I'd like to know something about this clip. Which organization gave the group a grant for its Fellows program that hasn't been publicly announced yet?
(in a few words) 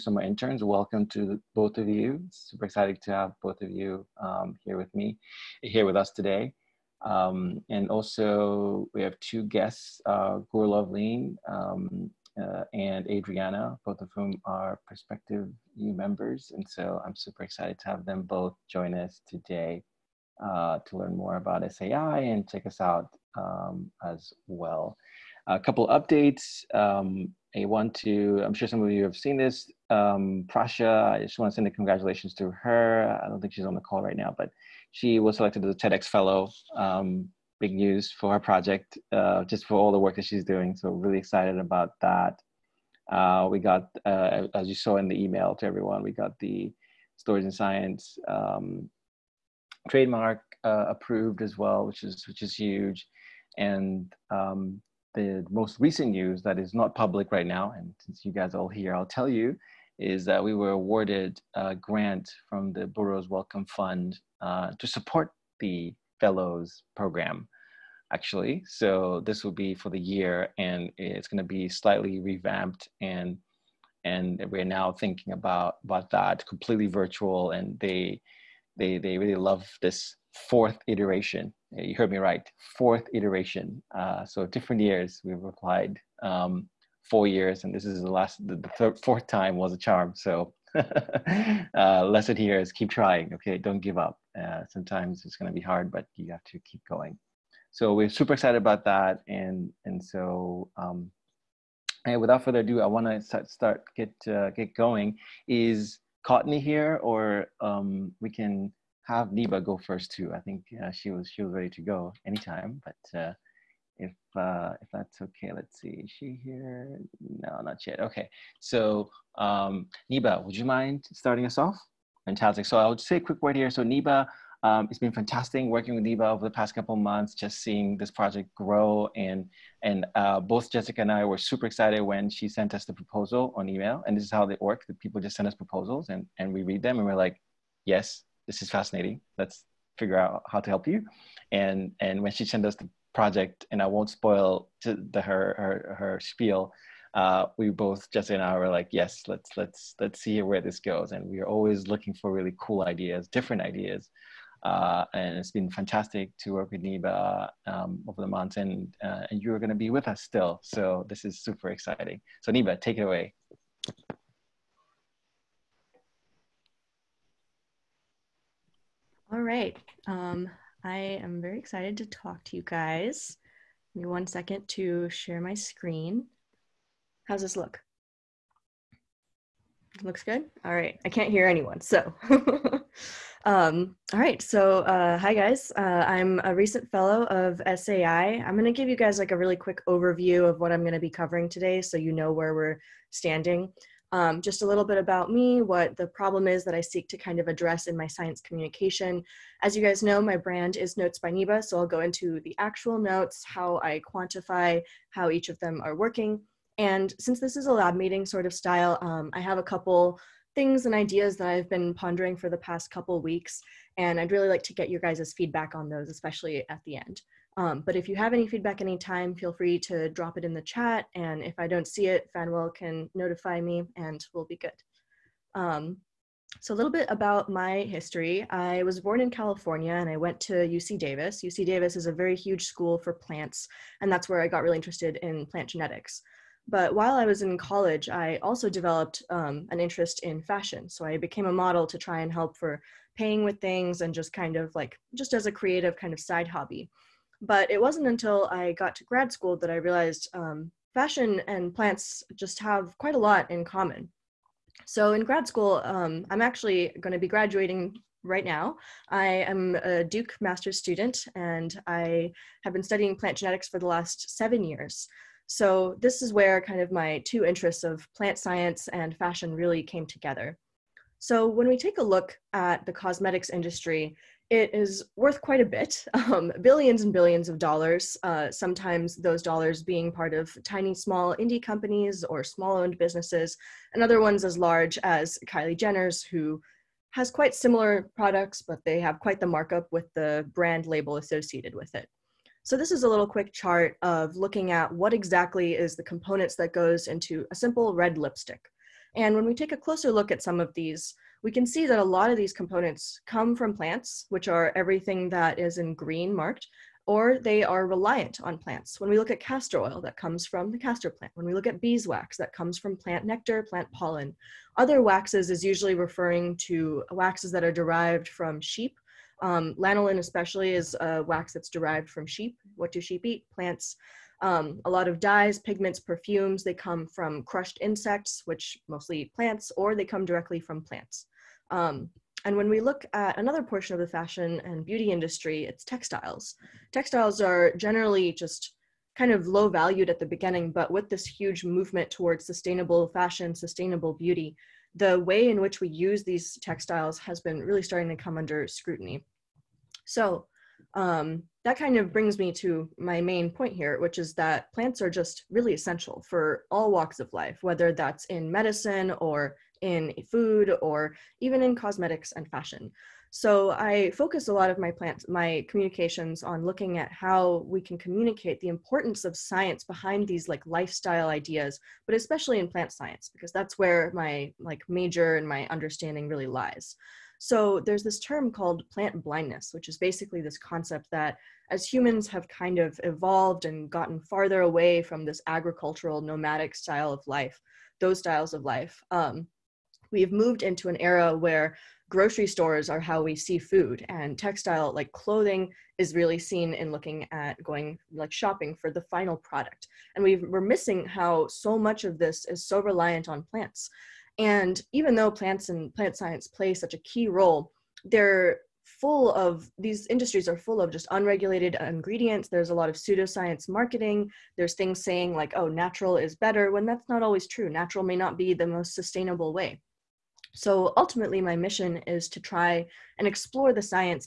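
Burroughs Wellcome Fund.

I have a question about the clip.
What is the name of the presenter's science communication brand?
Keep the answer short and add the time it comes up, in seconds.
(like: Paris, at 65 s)
Notes by Niba, at 200 s.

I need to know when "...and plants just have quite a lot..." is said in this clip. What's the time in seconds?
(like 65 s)
251 s.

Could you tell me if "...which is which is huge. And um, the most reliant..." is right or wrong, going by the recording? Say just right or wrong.
wrong.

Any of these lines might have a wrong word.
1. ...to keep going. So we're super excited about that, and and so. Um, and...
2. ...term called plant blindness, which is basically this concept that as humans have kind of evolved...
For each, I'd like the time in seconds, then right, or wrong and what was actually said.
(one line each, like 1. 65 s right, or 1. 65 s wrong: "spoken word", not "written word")
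1. 96 s right
2. 378 s right.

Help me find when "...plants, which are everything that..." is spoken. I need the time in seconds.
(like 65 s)
303 s.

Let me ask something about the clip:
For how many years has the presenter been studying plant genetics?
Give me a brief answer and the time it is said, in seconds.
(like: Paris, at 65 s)
7, at 264 s.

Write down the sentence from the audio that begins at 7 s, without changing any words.
Um, and also we have two guests, uh, Gore Loveline um, uh, and Adriana, both of whom are prospective new members.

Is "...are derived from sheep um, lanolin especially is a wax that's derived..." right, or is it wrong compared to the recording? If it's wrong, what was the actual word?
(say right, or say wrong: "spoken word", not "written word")
right.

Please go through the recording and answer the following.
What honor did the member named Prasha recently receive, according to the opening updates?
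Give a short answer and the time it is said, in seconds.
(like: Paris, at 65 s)
TEDx Fellow, at 35 s.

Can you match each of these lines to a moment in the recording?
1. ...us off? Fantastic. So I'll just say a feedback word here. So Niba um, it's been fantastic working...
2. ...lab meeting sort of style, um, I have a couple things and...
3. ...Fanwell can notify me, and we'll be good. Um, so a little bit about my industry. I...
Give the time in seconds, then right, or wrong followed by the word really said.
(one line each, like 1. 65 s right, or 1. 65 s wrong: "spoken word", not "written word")
1. 121 s wrong: "quick", not "feedback"
2. 207 s right
3. 222 s wrong: "history", not "industry".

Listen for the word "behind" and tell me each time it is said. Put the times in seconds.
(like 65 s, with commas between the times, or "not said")
369 s.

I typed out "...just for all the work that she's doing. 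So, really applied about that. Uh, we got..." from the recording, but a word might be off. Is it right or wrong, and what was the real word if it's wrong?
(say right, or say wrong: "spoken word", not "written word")
wrong: "excited", not "applied".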